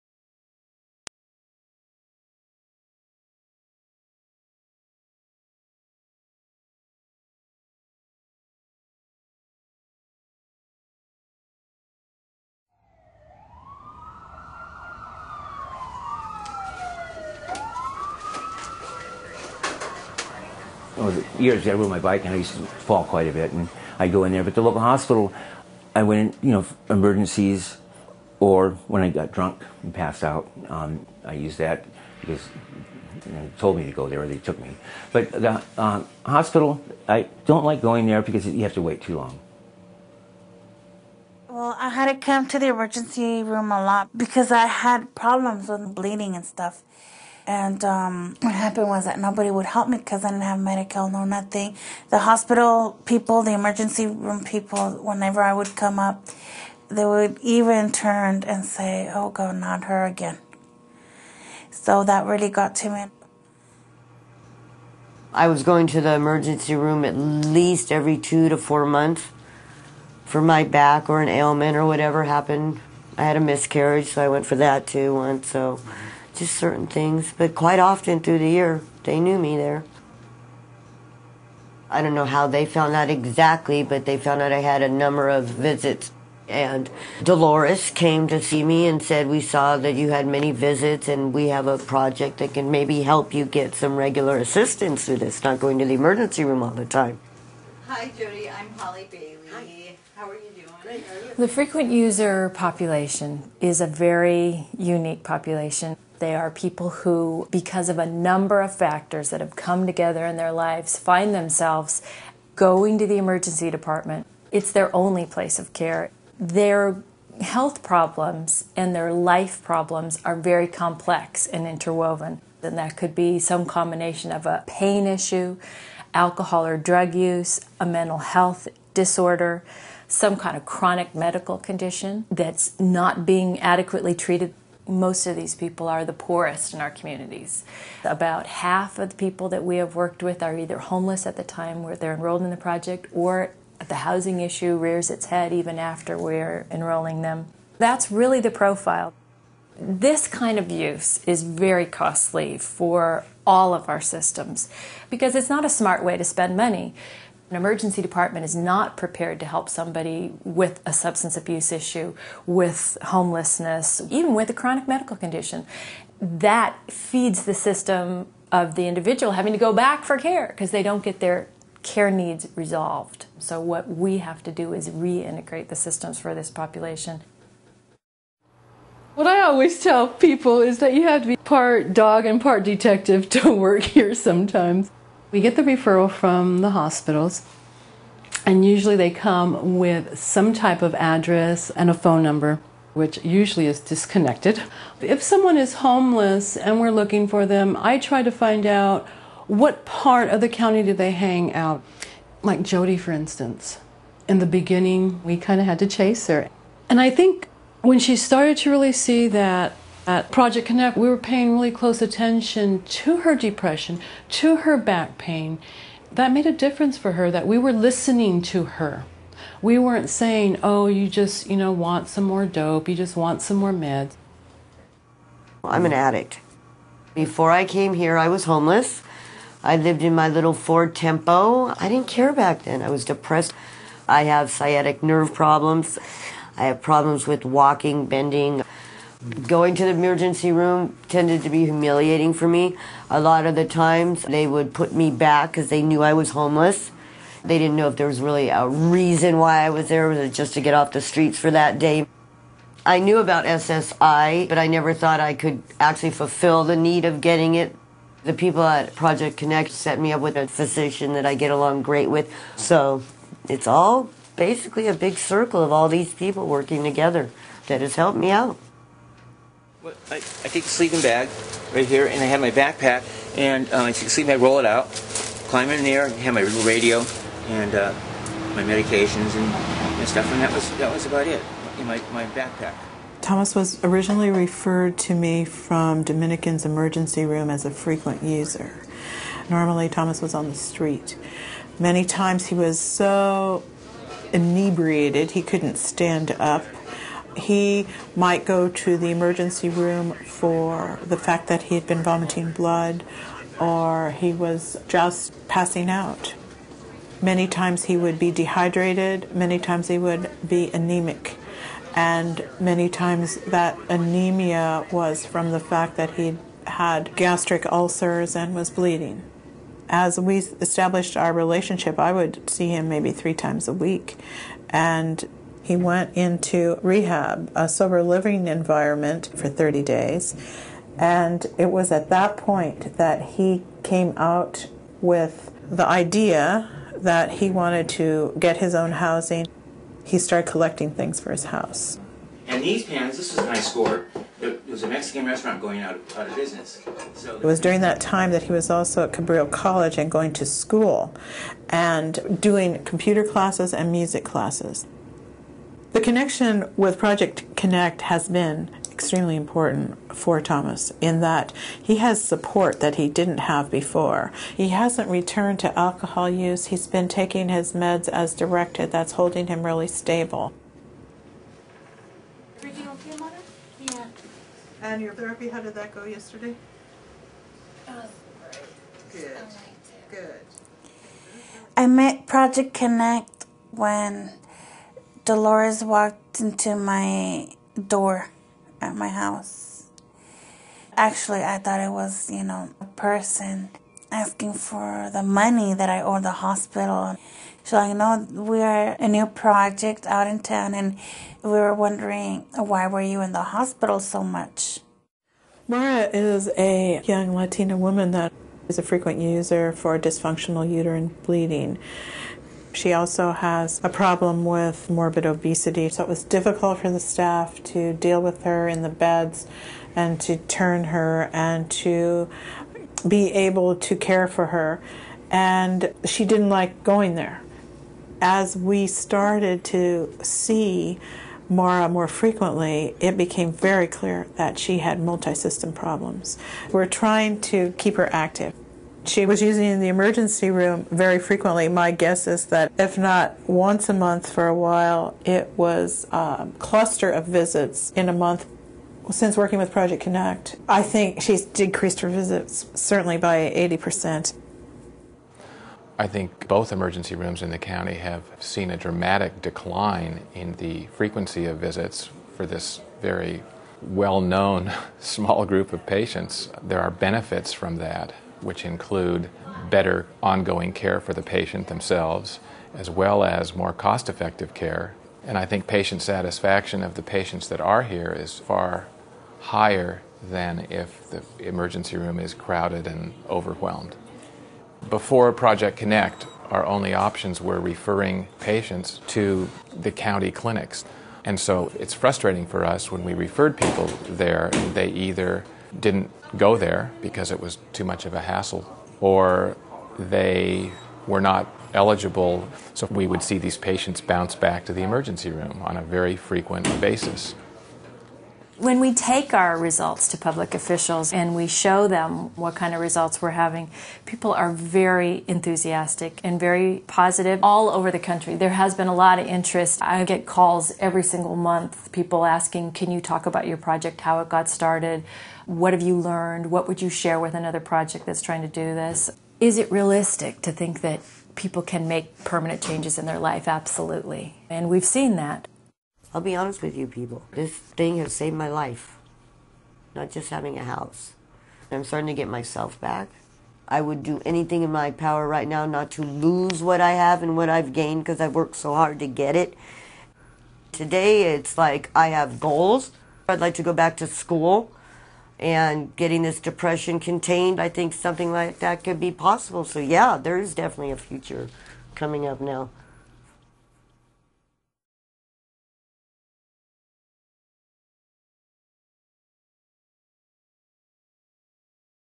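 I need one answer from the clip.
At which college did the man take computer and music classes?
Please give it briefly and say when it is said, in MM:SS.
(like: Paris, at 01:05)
Cabrillo College, at 05:49.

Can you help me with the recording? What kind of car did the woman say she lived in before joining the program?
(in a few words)
Ford Tempo.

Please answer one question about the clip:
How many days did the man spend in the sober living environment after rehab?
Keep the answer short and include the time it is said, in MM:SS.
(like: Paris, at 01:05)
30, at 05:29.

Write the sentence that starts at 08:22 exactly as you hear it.
So we would see these patients bounce back to the emergency room on a very frequent basis.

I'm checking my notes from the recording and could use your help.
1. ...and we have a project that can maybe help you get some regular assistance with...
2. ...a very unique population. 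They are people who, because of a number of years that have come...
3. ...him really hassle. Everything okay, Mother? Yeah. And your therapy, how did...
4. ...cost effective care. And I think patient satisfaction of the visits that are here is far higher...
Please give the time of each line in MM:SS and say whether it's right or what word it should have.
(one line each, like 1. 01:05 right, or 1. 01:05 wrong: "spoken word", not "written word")
1. 01:31 right
2. 01:43 wrong: "factors", not "years"
3. 06:09 wrong: "stable", not "hassle"
4. 07:53 wrong: "patients", not "visits".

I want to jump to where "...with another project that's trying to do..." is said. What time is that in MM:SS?
08:47.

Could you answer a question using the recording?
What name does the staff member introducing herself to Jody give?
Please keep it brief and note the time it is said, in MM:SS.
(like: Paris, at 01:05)
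Holly Bailey, at 01:38.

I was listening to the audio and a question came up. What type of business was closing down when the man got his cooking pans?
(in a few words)
Mexican restaurant.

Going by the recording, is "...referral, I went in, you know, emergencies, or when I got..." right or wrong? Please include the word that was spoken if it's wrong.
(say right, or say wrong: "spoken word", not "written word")
wrong: "hospital", not "referral".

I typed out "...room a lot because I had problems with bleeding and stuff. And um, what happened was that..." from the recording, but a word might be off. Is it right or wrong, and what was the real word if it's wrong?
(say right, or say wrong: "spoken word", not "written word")
right.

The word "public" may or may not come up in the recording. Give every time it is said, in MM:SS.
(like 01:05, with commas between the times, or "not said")
08:30.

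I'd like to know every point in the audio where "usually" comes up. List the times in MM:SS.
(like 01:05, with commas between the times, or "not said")
03:08, 03:13.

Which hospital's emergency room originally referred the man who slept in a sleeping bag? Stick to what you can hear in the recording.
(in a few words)
Dominican.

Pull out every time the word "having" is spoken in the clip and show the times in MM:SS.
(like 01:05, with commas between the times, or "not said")
02:49, 08:33, 09:00.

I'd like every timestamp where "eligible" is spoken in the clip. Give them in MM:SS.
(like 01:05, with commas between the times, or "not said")
08:21.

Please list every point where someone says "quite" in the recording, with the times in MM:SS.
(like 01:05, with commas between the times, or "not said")
00:23, 01:17.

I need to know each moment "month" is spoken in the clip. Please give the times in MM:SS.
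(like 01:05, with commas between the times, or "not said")
01:08, 07:23, 07:28, 08:41.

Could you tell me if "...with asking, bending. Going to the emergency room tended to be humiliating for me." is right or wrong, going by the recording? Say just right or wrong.
wrong.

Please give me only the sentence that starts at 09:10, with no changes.
Today, it's like I have goals.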